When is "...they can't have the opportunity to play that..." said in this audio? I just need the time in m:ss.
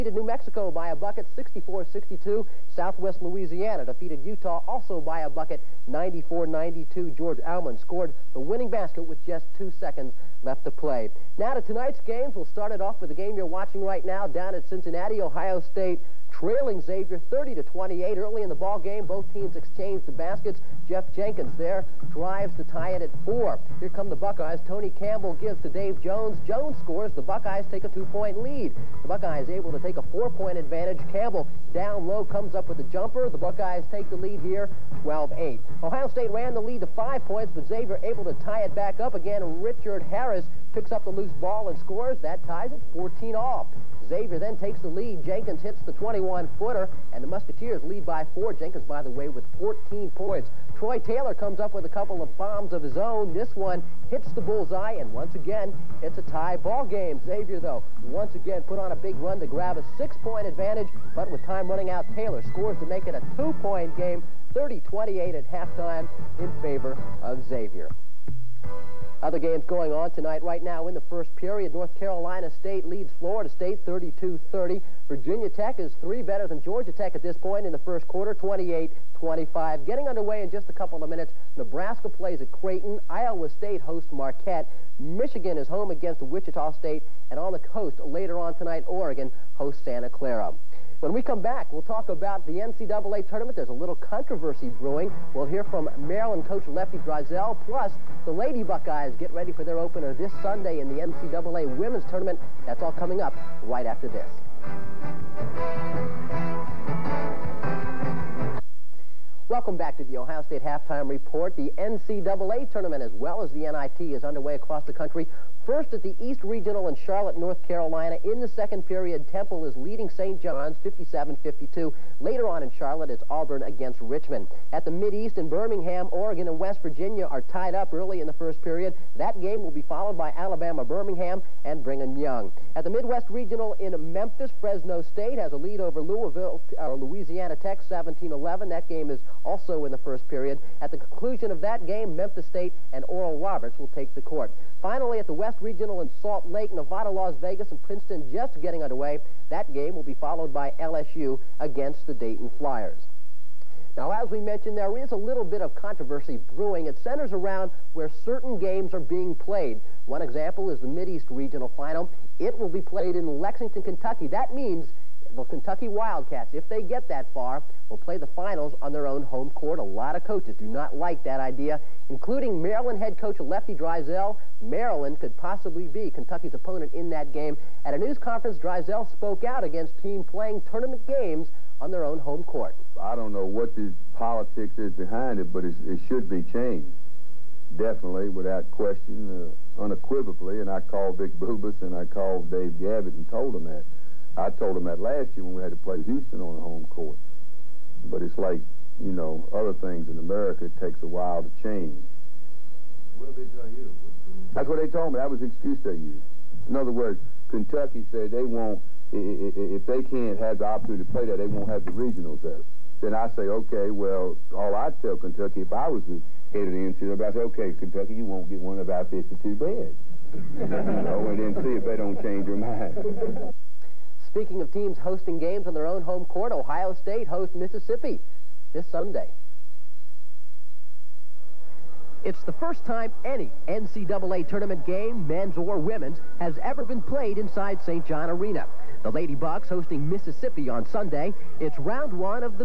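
3:29.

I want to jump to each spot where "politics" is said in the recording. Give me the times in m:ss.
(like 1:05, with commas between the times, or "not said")
3:04.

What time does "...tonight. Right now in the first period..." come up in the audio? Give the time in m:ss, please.
1:10.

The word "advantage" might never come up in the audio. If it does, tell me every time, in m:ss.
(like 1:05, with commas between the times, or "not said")
0:30, 1:00.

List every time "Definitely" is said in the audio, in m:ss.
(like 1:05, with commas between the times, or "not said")
3:07.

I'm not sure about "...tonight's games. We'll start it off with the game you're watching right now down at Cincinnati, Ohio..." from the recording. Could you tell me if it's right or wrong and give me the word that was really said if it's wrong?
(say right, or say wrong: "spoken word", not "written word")
right.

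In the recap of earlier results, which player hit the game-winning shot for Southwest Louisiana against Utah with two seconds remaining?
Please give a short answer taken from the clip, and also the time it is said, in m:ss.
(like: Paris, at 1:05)
George Almond, at 0:07.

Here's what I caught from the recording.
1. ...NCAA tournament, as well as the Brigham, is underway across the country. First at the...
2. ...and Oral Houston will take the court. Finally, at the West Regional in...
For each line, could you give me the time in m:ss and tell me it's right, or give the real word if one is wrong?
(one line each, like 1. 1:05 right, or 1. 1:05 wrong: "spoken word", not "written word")
1. 1:51 wrong: "NIT", not "Brigham"
2. 2:22 wrong: "Roberts", not "Houston".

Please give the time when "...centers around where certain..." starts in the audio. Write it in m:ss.
2:37.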